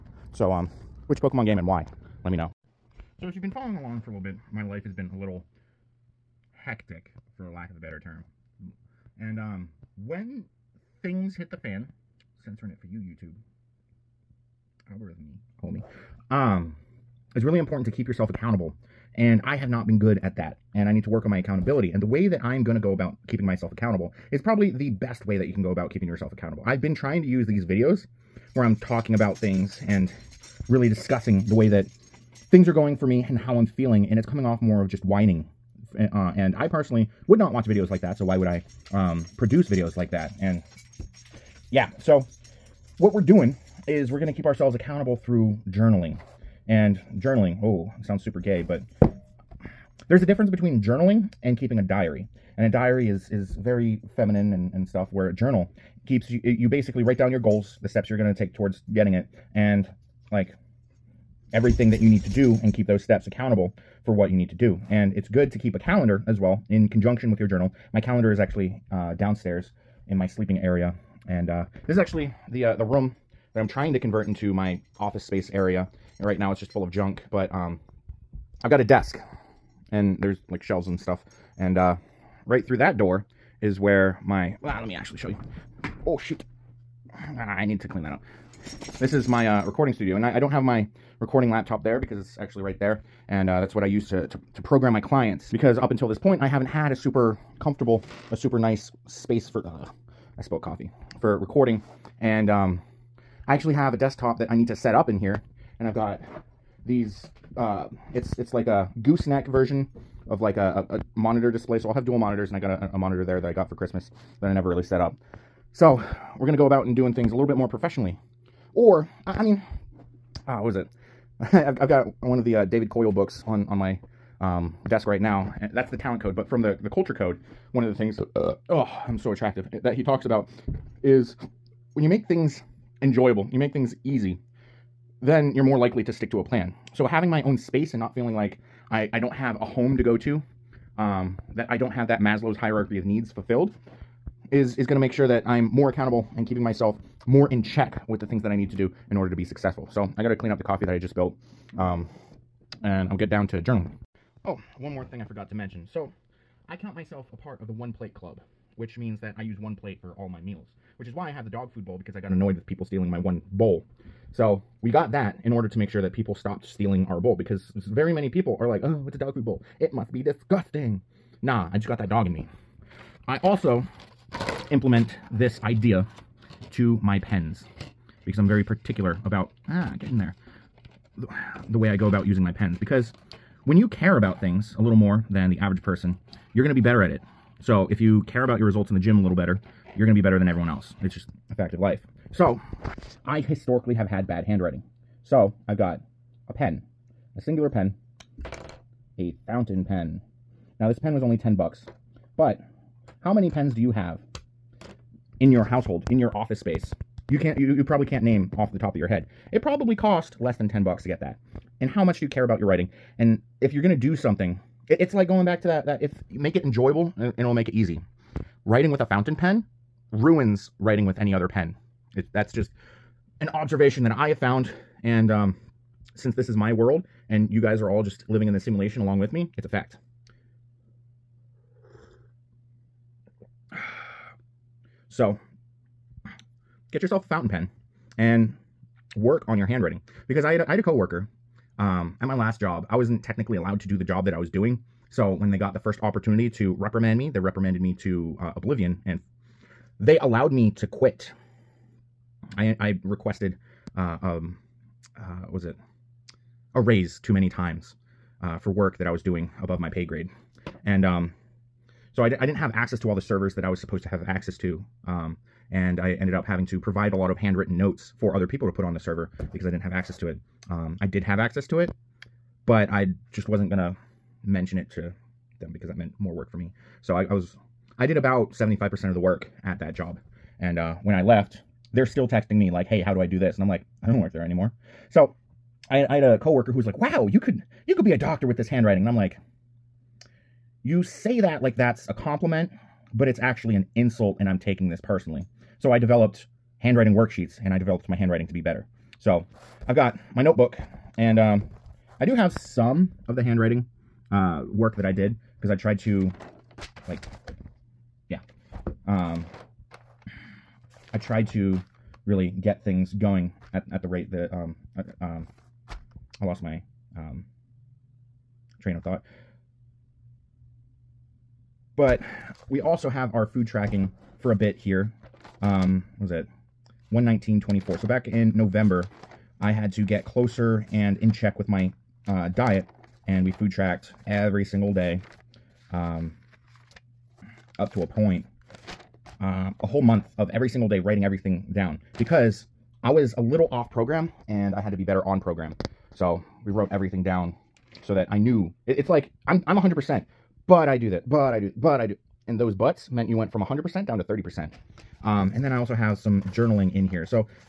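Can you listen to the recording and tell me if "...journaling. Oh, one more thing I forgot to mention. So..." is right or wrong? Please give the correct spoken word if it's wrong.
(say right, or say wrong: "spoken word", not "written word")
right.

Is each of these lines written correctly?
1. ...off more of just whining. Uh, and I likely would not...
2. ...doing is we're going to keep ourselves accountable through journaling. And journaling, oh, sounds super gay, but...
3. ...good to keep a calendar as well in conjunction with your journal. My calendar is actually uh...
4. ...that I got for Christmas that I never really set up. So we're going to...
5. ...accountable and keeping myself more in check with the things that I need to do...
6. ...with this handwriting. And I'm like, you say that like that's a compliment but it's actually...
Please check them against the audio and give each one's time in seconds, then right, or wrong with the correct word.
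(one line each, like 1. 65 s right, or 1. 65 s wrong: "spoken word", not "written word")
1. 34 s wrong: "personally", not "likely"
2. 43 s right
3. 65 s right
4. 113 s right
5. 145 s right
6. 288 s right.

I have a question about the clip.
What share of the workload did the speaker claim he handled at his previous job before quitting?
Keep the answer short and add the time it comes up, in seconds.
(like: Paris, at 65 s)
75%, at 278 s.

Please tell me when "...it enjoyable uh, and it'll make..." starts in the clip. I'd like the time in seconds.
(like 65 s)
216 s.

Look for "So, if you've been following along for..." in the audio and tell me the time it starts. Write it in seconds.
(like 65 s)
3 s.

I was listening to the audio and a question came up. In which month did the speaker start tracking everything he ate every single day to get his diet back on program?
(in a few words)
November.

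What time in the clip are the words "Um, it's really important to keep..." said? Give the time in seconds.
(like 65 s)
16 s.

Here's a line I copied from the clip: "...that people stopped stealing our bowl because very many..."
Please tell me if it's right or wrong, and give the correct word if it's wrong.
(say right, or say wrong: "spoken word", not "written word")
right.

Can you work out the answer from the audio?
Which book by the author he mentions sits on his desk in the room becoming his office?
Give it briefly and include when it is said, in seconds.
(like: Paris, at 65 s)
The Talent Code, at 125 s.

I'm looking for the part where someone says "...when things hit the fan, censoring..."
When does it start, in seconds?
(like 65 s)
10 s.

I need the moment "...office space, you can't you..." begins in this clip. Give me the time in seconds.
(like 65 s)
206 s.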